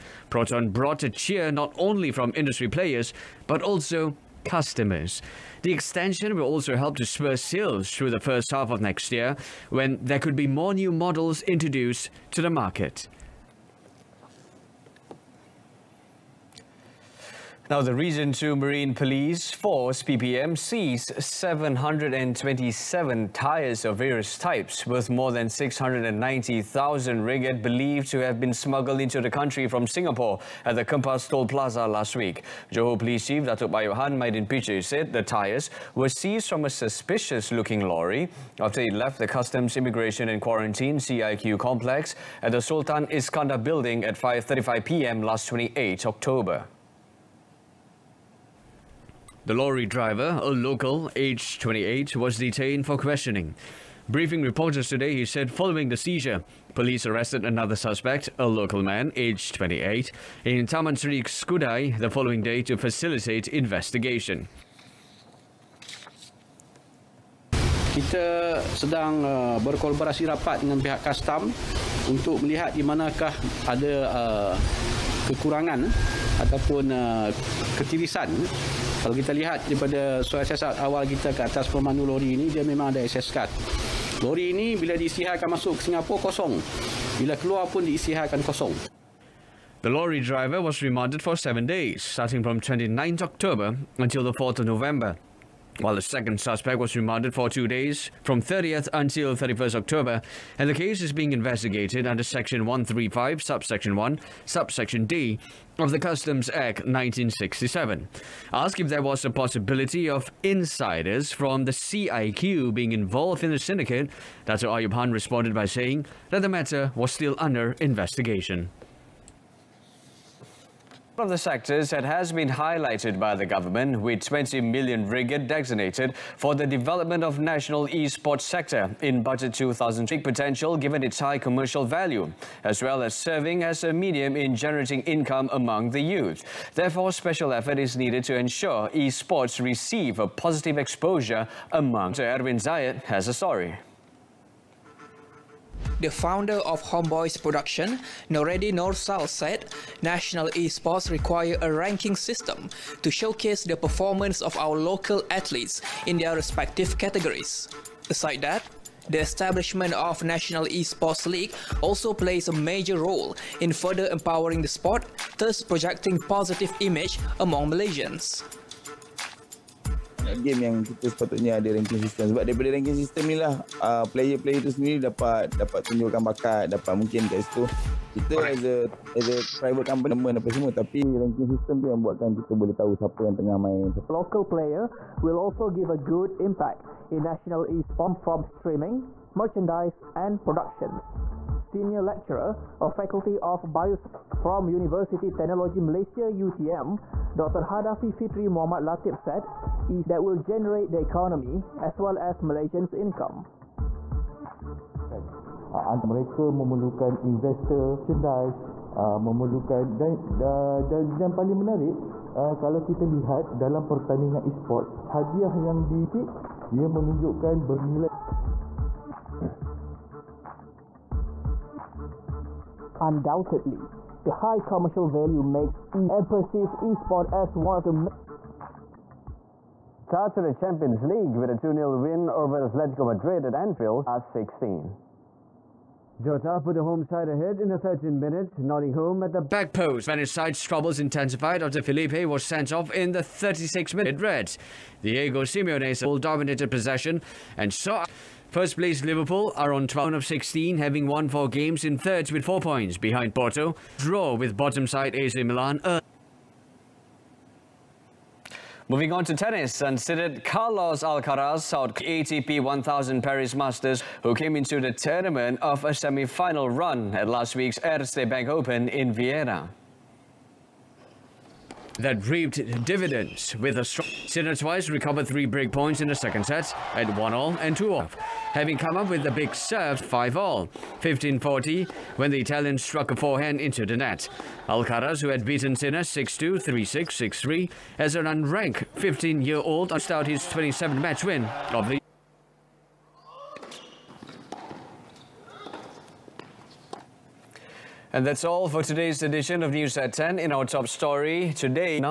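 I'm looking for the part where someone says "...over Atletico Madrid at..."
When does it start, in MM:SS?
03:52.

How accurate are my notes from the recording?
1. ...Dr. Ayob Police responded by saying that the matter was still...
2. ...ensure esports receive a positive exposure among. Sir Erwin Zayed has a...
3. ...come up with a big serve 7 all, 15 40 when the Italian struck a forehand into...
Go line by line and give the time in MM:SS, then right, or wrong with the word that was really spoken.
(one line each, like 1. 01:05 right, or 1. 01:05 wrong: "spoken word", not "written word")
1. 01:54 wrong: "Khan", not "Police"
2. 02:18 right
3. 04:38 wrong: "5", not "7".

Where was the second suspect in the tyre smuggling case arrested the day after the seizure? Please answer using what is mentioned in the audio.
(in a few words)
Taman Sri Skudai.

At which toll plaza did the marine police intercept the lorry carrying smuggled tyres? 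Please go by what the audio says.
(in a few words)
Kempas Toll Plaza.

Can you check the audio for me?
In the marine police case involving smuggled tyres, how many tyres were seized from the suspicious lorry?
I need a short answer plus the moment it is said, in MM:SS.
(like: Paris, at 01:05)
727, at 00:21.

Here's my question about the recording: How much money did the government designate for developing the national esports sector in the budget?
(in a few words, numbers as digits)
20 million ringgit.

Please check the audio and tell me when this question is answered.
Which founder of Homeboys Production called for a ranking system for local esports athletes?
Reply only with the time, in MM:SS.
02:28.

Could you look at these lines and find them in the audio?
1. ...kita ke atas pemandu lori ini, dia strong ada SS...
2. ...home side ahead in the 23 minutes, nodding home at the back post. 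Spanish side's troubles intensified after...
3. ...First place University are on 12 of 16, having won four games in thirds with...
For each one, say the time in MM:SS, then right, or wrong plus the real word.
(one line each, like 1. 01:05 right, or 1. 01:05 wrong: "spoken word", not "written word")
1. 01:21 wrong: "memang", not "strong"
2. 03:56 wrong: "13", not "23"
3. 04:08 wrong: "Liverpool", not "University".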